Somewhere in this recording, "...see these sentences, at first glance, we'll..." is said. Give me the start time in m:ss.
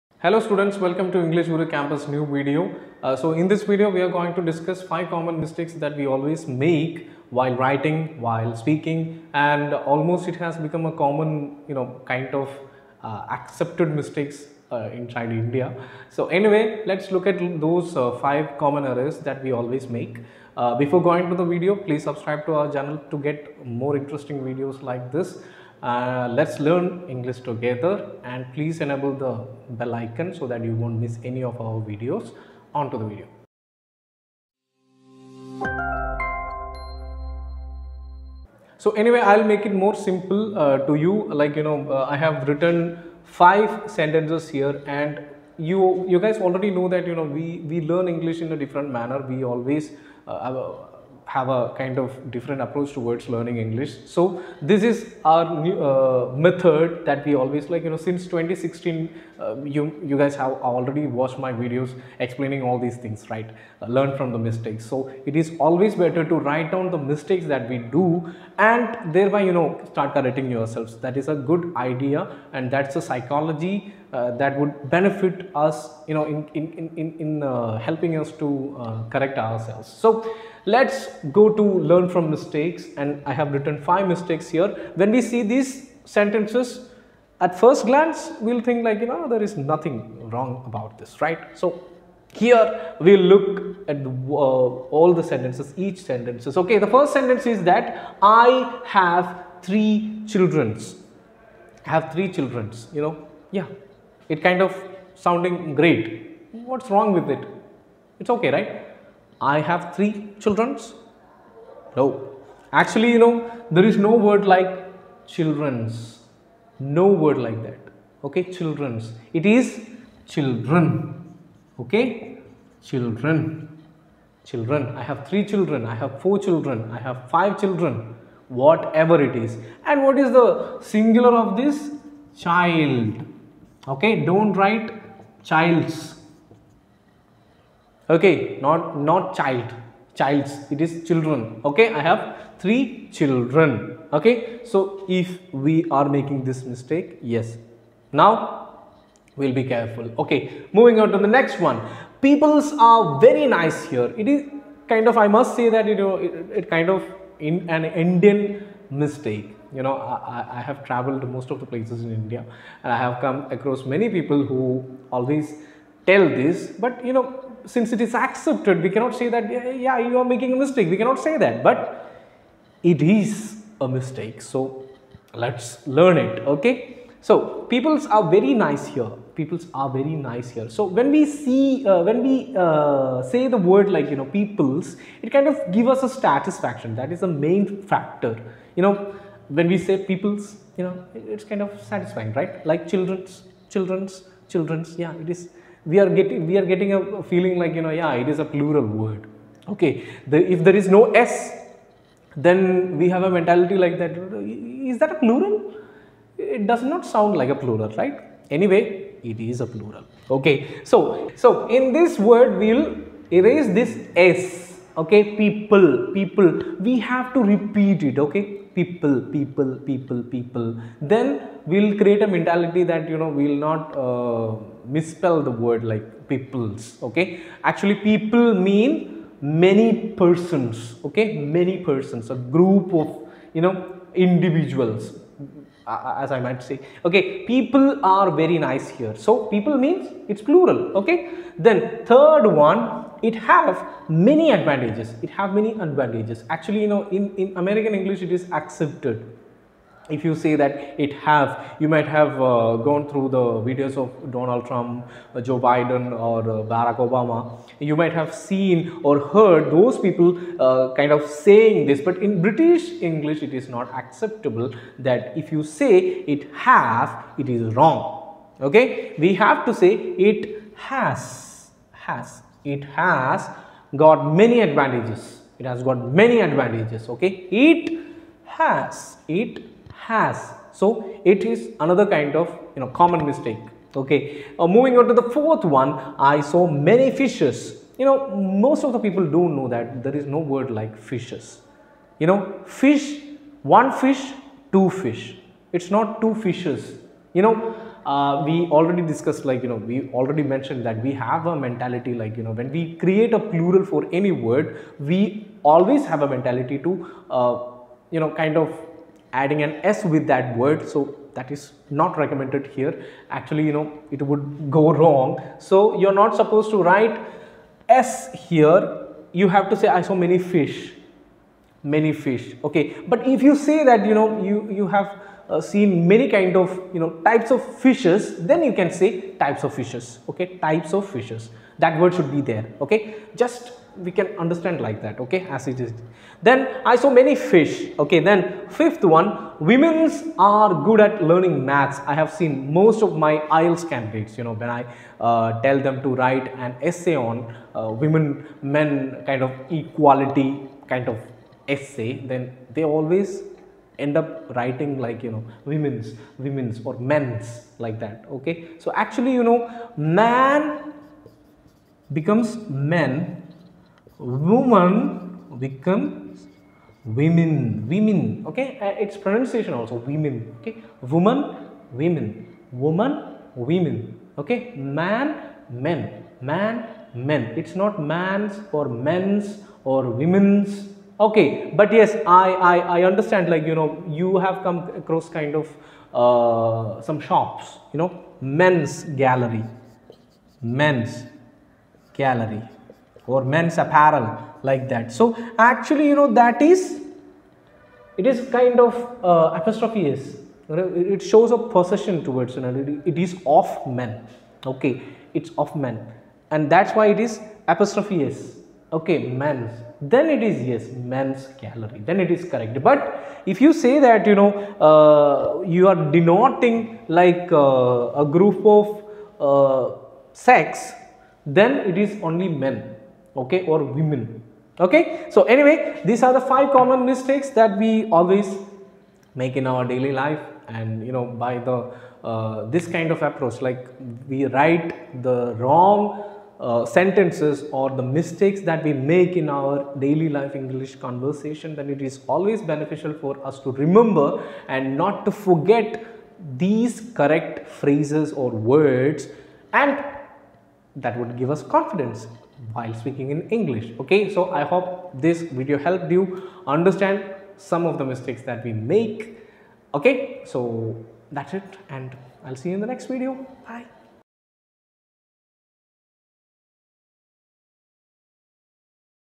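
1:25.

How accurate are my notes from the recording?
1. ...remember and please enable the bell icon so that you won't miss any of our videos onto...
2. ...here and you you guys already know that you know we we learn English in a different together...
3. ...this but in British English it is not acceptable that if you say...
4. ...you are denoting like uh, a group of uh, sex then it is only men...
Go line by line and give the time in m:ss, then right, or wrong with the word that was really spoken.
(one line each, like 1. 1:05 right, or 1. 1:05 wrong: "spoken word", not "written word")
1. 0:27 wrong: "together", not "remember"
2. 0:44 wrong: "manner", not "together"
3. 4:21 right
4. 6:55 right.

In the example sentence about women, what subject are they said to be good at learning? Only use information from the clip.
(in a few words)
maths.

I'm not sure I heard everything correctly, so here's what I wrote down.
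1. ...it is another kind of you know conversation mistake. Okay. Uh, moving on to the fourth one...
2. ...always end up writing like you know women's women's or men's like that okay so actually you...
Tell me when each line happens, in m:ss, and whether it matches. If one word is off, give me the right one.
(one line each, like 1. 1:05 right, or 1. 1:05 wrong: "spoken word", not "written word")
1. 4:41 wrong: "common", not "conversation"
2. 5:52 right.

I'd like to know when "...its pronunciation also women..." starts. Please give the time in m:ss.
6:09.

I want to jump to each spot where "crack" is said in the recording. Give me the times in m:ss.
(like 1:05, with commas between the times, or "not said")
not said.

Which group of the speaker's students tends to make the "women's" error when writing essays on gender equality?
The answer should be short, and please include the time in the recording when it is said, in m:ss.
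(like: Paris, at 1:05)
IELTS candidates, at 5:43.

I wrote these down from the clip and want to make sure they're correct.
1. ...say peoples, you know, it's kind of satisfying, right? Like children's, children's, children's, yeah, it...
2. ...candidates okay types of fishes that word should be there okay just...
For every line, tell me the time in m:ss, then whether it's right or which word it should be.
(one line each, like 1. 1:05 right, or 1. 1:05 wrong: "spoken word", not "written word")
1. 3:09 right
2. 5:29 wrong: "fishes", not "candidates".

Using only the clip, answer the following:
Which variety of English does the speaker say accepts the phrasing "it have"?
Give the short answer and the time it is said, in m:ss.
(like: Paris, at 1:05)
American English, at 4:07.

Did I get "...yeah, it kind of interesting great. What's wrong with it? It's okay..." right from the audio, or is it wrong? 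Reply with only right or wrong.
wrong.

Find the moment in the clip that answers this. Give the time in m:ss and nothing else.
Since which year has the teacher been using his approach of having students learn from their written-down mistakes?
0:58.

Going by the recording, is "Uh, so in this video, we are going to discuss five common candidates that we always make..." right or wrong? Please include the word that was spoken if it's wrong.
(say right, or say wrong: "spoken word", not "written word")
wrong: "mistakes", not "candidates".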